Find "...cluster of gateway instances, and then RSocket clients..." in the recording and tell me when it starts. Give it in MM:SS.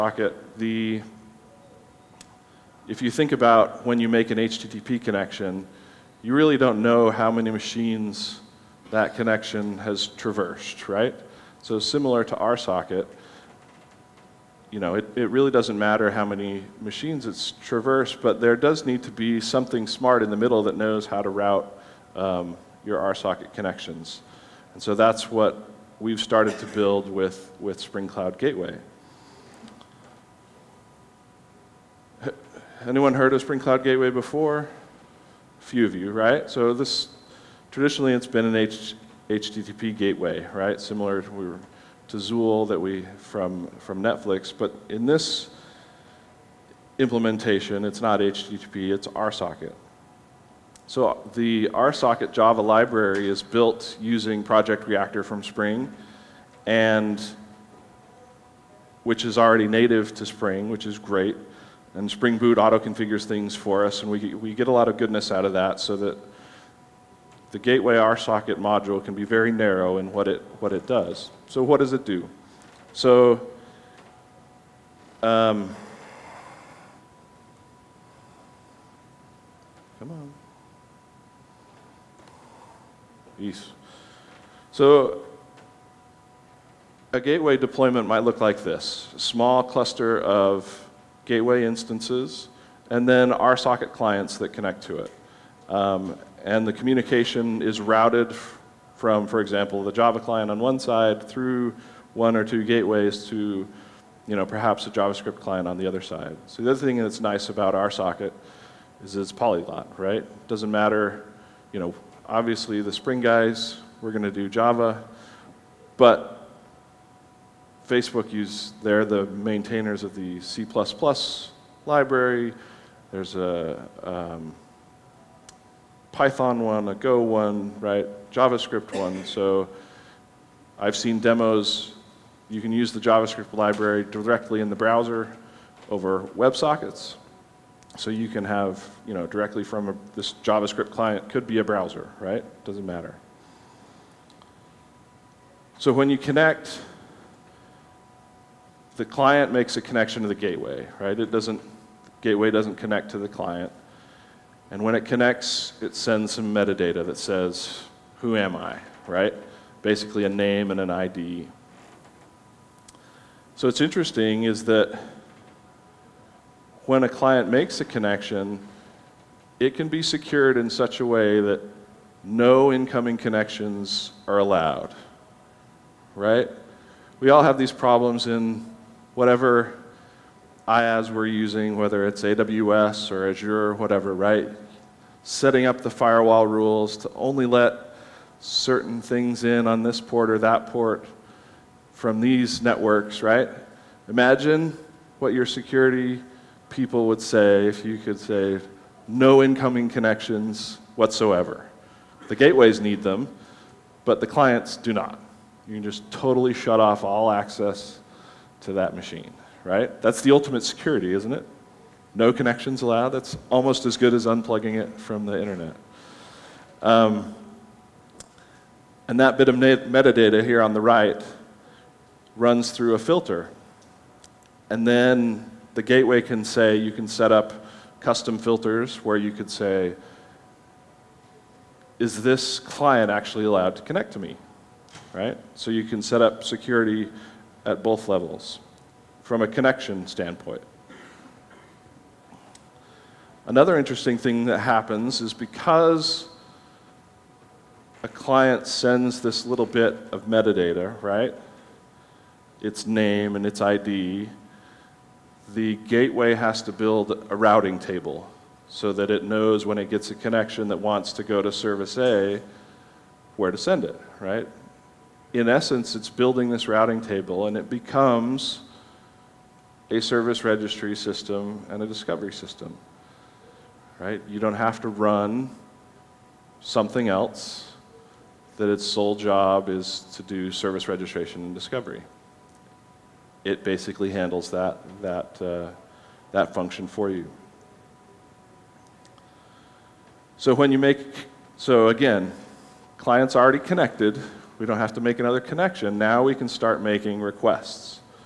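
01:29.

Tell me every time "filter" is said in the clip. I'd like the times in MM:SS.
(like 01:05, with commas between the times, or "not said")
03:42, 03:48.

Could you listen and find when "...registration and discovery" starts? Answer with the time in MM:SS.
04:40.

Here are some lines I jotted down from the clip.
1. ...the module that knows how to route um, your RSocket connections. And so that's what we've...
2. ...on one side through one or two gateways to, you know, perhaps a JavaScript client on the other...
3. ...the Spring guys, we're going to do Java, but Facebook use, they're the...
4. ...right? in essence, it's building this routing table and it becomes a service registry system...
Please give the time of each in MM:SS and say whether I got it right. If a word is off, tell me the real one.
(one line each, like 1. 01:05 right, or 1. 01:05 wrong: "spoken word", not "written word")
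1. 00:20 wrong: "middle", not "module"
2. 01:40 right
3. 01:52 right
4. 04:24 right.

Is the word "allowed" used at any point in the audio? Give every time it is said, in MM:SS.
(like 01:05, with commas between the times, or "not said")
02:54, 03:32, 03:53.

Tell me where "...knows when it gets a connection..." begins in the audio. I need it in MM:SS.
04:19.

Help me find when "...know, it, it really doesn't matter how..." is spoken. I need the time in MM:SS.
00:14.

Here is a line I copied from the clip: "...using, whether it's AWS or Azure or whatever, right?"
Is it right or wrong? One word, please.
right.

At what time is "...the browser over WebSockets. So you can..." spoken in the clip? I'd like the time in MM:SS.
02:14.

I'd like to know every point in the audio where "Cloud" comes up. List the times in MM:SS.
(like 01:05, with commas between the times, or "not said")
00:28, 00:33.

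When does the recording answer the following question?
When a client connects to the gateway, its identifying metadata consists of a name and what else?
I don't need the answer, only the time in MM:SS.
02:40.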